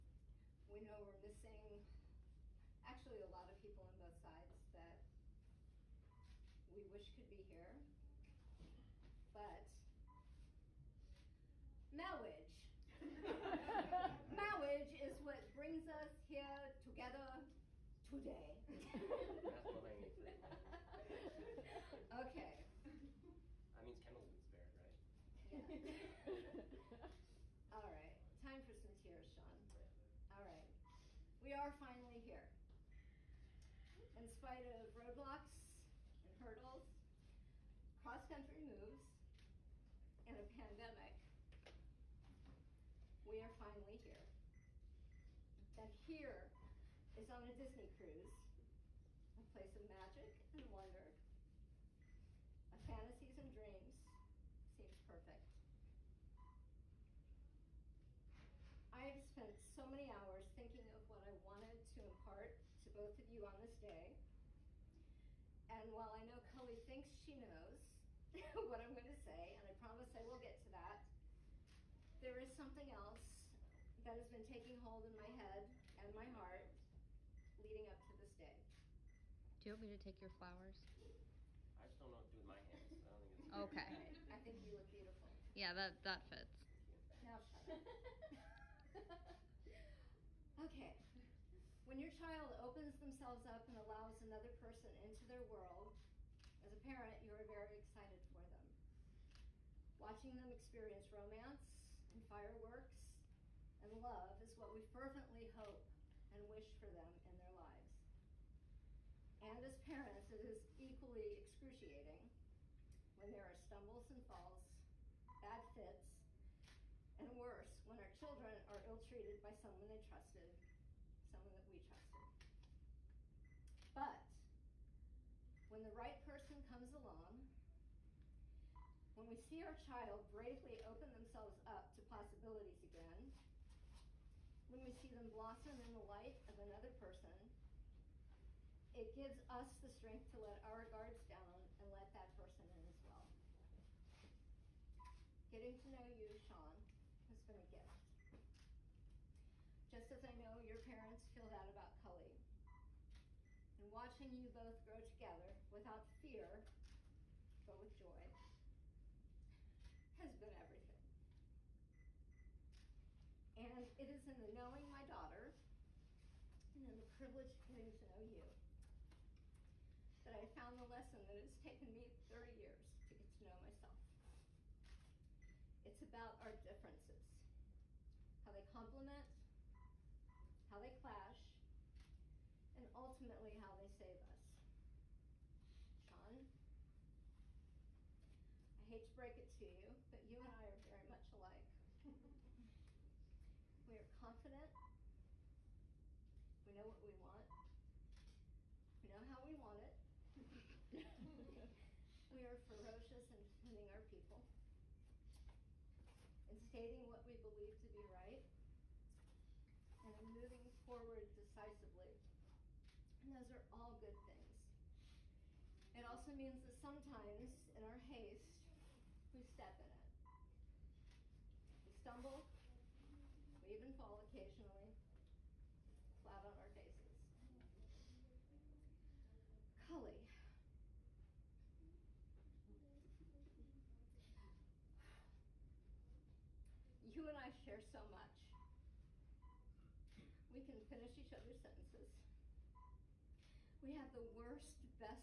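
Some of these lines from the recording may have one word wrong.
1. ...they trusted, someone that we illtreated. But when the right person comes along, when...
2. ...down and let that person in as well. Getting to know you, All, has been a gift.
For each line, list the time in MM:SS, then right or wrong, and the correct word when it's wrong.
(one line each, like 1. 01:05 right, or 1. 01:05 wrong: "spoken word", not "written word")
1. 01:59 wrong: "trusted", not "illtreated"
2. 02:21 wrong: "Sean", not "All".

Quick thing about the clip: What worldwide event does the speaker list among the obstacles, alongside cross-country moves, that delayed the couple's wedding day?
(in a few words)
a pandemic.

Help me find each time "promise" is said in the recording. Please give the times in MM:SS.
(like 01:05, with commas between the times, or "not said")
01:09.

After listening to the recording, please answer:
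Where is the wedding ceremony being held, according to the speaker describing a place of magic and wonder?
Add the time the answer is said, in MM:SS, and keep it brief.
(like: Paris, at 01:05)
Disney cruise, at 00:47.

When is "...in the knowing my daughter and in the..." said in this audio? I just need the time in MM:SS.
02:44.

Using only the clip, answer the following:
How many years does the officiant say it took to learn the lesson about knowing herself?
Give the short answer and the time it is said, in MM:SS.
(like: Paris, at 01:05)
30, at 02:52.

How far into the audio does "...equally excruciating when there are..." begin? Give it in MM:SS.
01:50.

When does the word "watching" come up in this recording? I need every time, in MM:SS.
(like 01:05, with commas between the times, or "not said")
01:39, 02:33.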